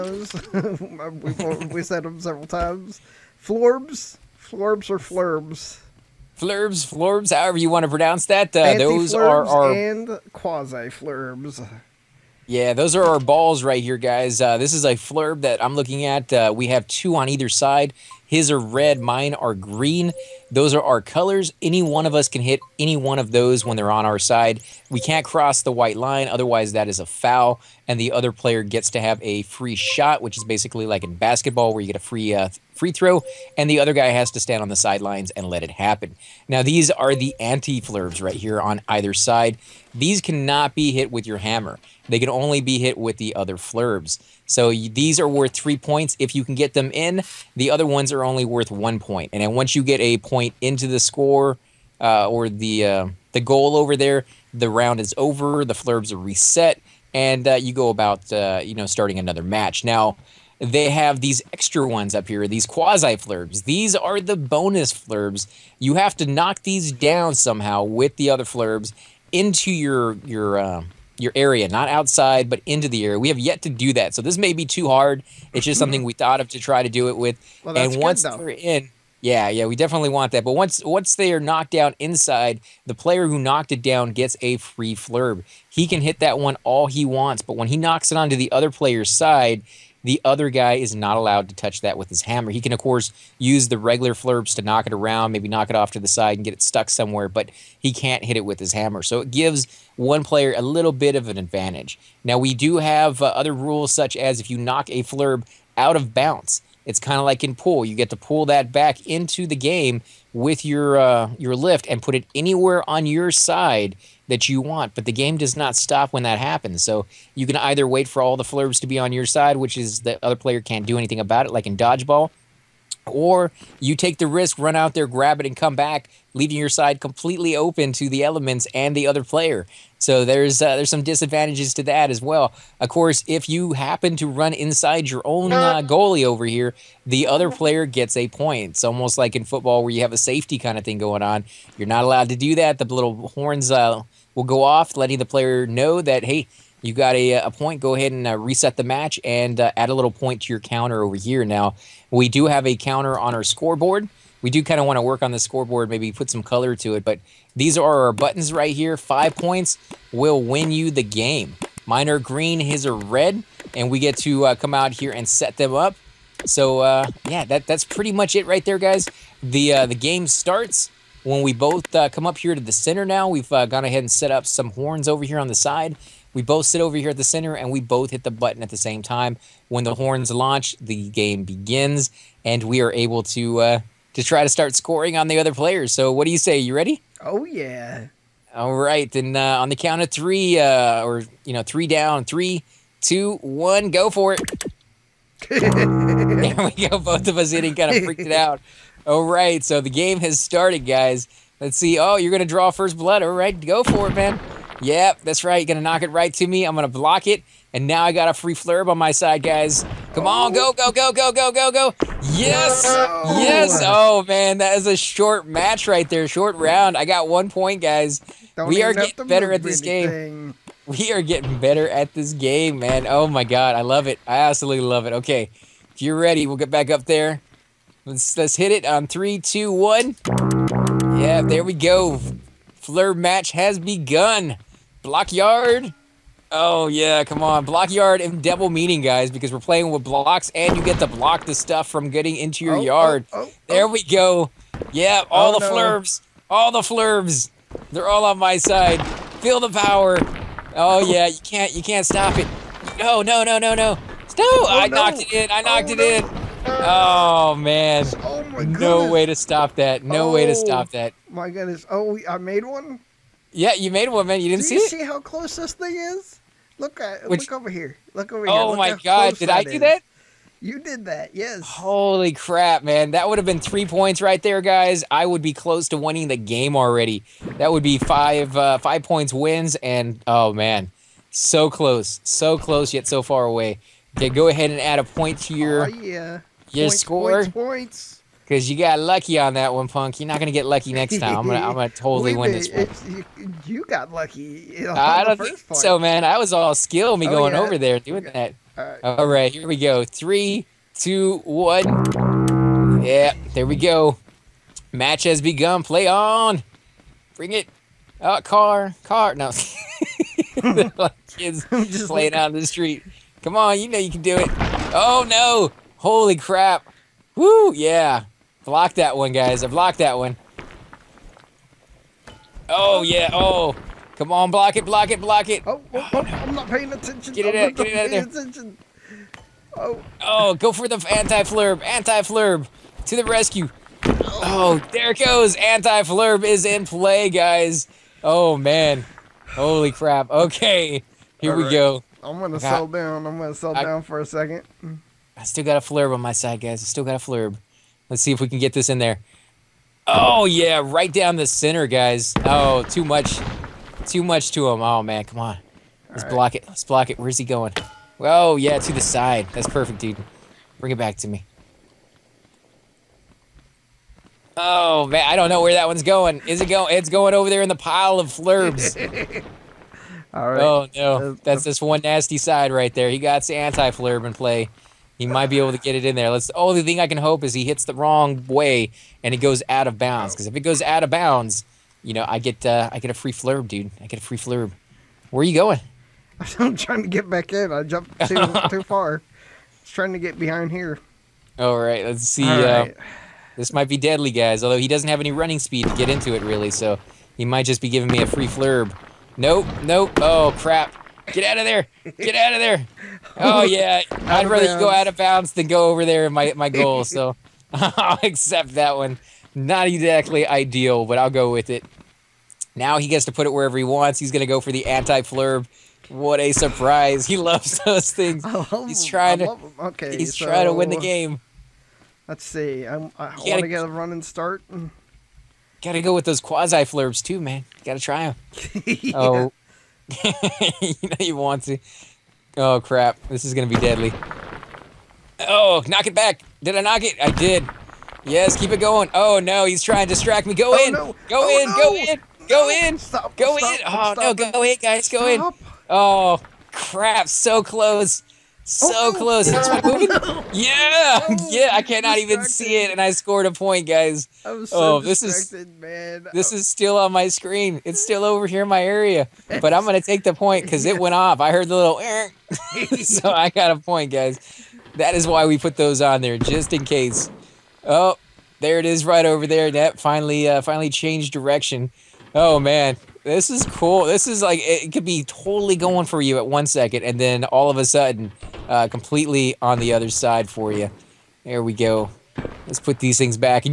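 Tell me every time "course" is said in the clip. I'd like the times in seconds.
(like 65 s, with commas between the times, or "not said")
92 s, 132 s.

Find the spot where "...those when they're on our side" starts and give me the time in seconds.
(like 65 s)
23 s.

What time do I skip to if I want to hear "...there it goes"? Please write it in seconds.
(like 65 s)
334 s.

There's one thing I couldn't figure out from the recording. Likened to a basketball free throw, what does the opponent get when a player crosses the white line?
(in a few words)
A free shot.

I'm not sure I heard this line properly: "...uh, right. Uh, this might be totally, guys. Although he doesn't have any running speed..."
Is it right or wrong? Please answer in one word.
wrong.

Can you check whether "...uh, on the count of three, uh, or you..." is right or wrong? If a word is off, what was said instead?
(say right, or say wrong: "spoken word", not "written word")
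right.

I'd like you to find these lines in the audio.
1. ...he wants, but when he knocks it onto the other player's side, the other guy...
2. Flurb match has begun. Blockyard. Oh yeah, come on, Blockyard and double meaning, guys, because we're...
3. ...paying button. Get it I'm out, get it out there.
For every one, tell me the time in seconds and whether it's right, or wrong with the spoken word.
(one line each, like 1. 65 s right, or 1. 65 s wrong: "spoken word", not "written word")
1. 86 s right
2. 232 s right
3. 326 s wrong: "attention", not "button".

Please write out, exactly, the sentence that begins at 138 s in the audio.
It's almost like in football where you have a safety kind of thing going on.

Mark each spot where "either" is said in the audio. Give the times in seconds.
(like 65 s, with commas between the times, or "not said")
17 s, 38 s, 117 s.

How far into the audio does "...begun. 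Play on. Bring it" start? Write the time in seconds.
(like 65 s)
305 s.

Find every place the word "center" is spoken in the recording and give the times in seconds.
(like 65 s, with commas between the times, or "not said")
172 s, 177 s, 351 s.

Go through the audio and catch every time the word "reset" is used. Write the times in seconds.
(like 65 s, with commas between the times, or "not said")
56 s, 148 s.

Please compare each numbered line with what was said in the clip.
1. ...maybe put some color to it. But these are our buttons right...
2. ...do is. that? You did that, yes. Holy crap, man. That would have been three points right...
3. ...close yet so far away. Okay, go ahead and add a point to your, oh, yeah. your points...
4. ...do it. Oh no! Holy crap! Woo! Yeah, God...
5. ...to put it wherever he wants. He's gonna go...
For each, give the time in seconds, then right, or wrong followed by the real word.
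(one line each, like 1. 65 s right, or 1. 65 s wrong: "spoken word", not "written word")
1. 155 s right
2. 269 s right
3. 282 s right
4. 314 s wrong: "Block", not "God"
5. 413 s right.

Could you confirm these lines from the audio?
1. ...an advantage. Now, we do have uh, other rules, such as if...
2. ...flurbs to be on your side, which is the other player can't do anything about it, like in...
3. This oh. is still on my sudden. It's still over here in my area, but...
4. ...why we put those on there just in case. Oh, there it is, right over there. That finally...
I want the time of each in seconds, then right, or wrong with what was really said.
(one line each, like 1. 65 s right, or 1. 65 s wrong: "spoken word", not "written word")
1. 101 s right
2. 118 s right
3. 456 s wrong: "screen", not "sudden"
4. 465 s right.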